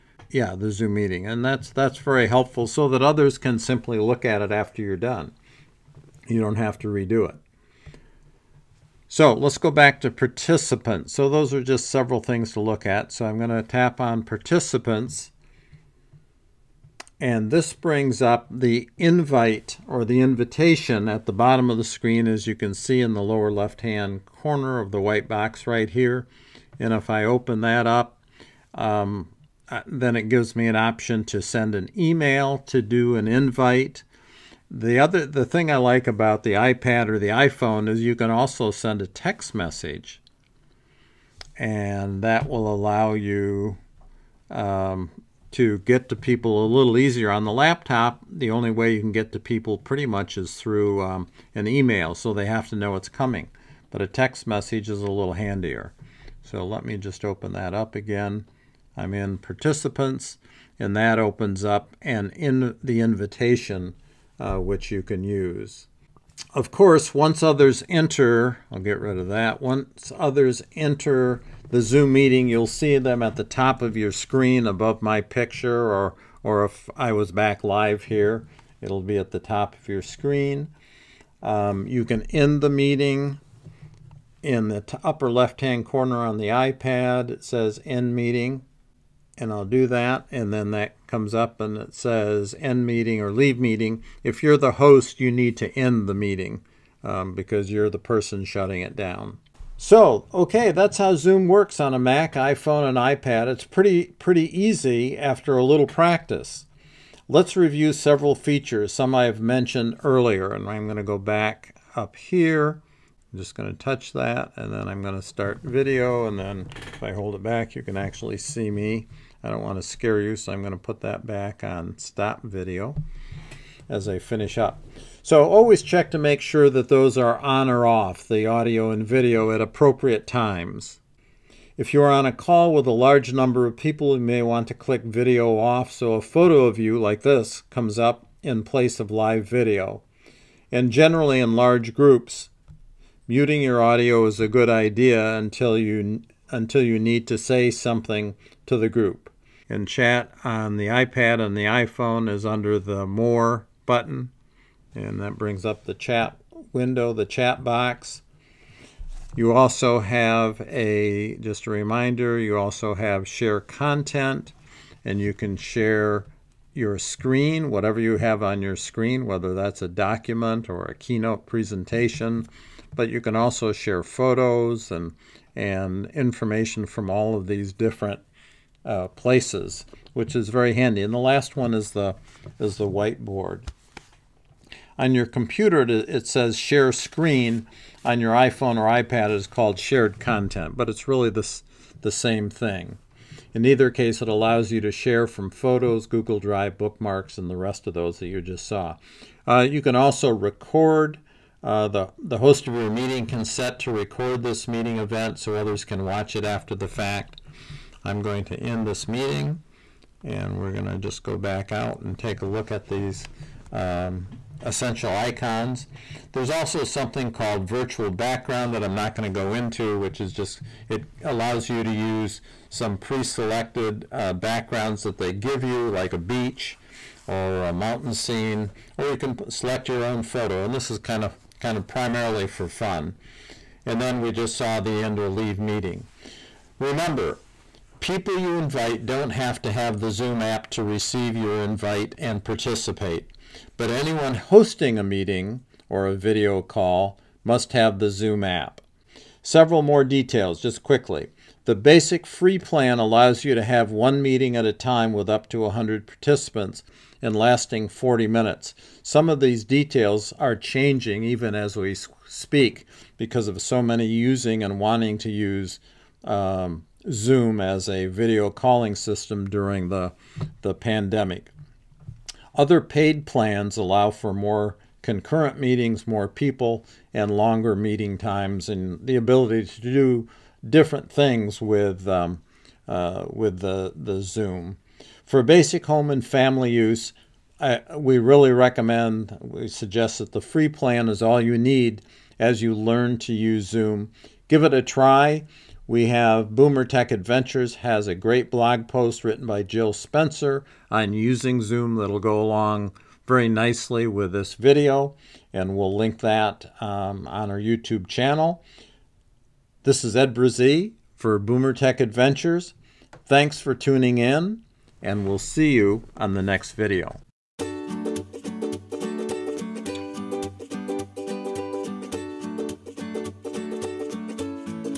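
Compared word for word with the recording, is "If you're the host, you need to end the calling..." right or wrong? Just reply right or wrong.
wrong.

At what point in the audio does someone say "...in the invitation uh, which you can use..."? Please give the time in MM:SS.
01:02.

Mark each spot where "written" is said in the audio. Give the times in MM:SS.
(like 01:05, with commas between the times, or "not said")
04:59.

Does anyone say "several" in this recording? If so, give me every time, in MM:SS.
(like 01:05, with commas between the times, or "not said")
00:11, 01:47, 04:09.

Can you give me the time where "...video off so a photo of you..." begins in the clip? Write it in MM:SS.
02:15.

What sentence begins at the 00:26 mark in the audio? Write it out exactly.
And if I open that up, um, uh, then it gives me an option to send an email, to do an invite.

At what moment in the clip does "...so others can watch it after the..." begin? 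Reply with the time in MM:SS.
03:25.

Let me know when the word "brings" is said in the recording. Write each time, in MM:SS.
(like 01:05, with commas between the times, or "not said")
00:17, 02:35.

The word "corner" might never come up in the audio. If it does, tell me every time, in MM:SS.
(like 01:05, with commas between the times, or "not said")
00:24, 01:25.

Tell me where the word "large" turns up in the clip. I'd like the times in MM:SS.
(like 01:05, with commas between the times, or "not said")
02:12, 02:21.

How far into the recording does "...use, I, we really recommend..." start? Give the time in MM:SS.
04:46.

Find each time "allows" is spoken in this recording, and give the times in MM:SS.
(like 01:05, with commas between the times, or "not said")
00:42, 03:14, 03:41, 04:12, 04:33.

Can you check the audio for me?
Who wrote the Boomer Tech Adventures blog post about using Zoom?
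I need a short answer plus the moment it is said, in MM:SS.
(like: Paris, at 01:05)
Jill Spencer, at 04:59.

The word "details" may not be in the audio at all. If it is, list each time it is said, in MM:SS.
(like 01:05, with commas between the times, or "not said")
04:10, 04:19.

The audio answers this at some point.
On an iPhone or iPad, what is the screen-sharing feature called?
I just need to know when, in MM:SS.
03:09.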